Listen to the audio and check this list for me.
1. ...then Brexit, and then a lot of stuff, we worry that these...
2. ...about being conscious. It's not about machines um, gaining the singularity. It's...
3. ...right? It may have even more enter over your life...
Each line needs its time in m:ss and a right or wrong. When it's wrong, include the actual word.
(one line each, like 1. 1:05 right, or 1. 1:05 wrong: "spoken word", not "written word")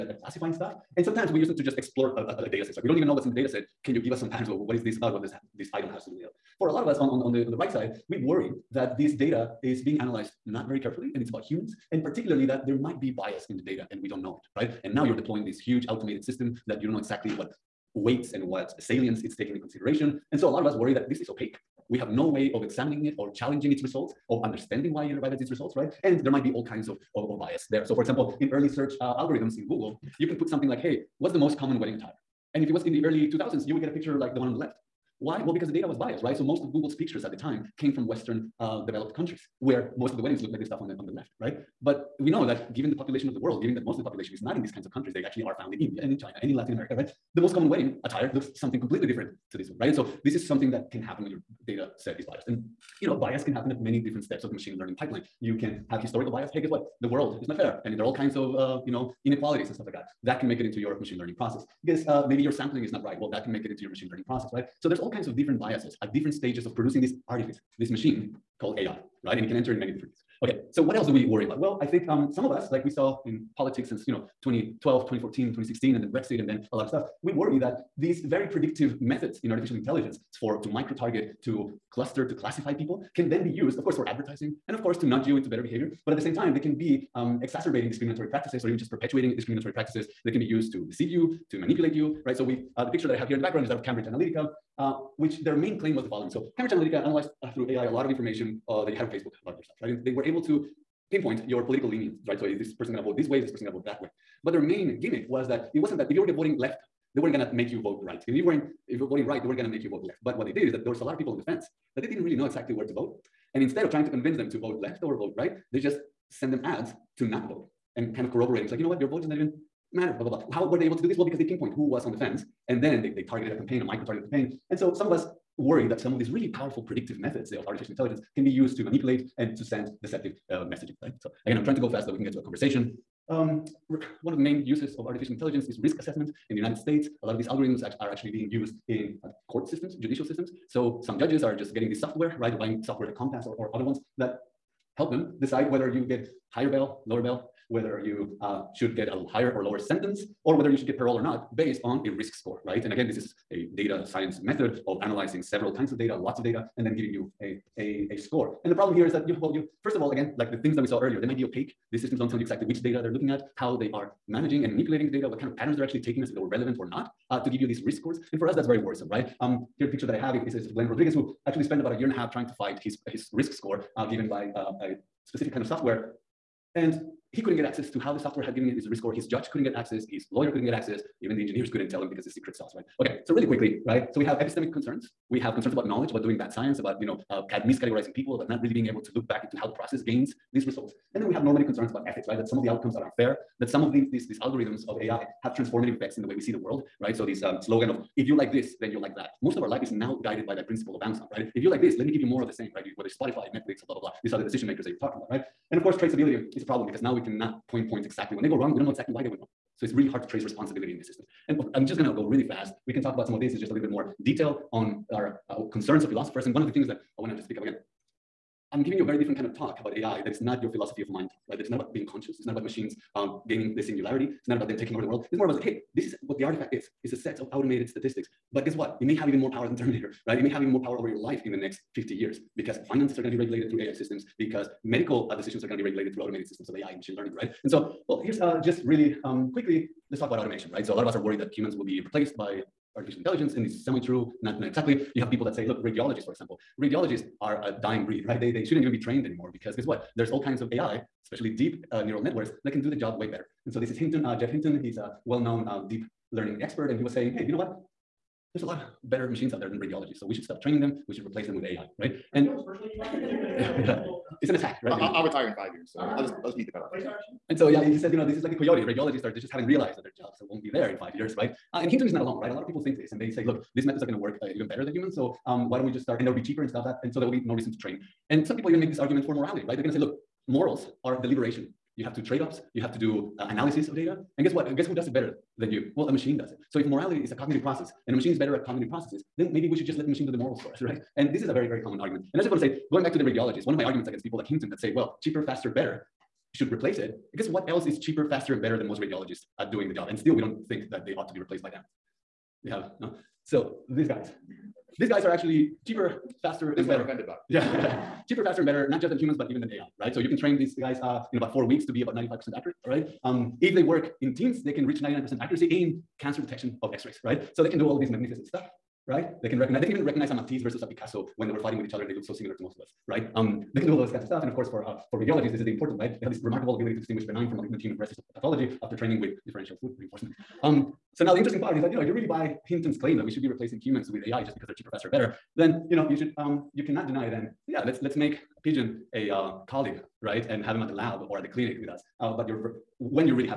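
1. 1:16 right
2. 3:41 right
3. 3:50 wrong: "power", not "enter".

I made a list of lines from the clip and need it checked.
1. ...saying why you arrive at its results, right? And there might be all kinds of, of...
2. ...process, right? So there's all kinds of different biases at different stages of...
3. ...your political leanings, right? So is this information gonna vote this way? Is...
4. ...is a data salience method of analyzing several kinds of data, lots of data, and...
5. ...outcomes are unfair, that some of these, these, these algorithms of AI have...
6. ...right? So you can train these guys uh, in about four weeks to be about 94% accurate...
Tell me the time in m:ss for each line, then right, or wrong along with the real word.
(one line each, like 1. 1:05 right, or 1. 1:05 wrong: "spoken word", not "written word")
1. 0:24 wrong: "understanding", not "saying"
2. 1:04 right
3. 1:41 wrong: "person", not "information"
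4. 2:33 wrong: "science", not "salience"
5. 3:12 right
6. 5:09 wrong: "95", not "94".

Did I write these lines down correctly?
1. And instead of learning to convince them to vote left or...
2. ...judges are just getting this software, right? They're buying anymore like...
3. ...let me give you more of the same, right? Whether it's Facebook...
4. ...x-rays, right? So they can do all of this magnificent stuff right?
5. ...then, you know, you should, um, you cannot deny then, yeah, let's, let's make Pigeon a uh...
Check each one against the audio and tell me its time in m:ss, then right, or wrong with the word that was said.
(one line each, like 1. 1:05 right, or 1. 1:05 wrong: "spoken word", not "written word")
1. 1:53 wrong: "trying", not "learning"
2. 2:21 wrong: "software", not "anymore"
3. 3:21 wrong: "Spotify", not "Facebook"
4. 5:16 right
5. 5:35 right.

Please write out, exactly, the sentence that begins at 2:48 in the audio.
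And for us, that's very worrisome, right?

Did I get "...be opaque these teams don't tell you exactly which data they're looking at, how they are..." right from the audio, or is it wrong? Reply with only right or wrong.
wrong.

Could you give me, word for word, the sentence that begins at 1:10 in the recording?
Okay, so what else do we worry about?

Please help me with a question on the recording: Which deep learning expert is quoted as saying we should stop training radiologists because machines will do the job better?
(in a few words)
Geoff Hinton.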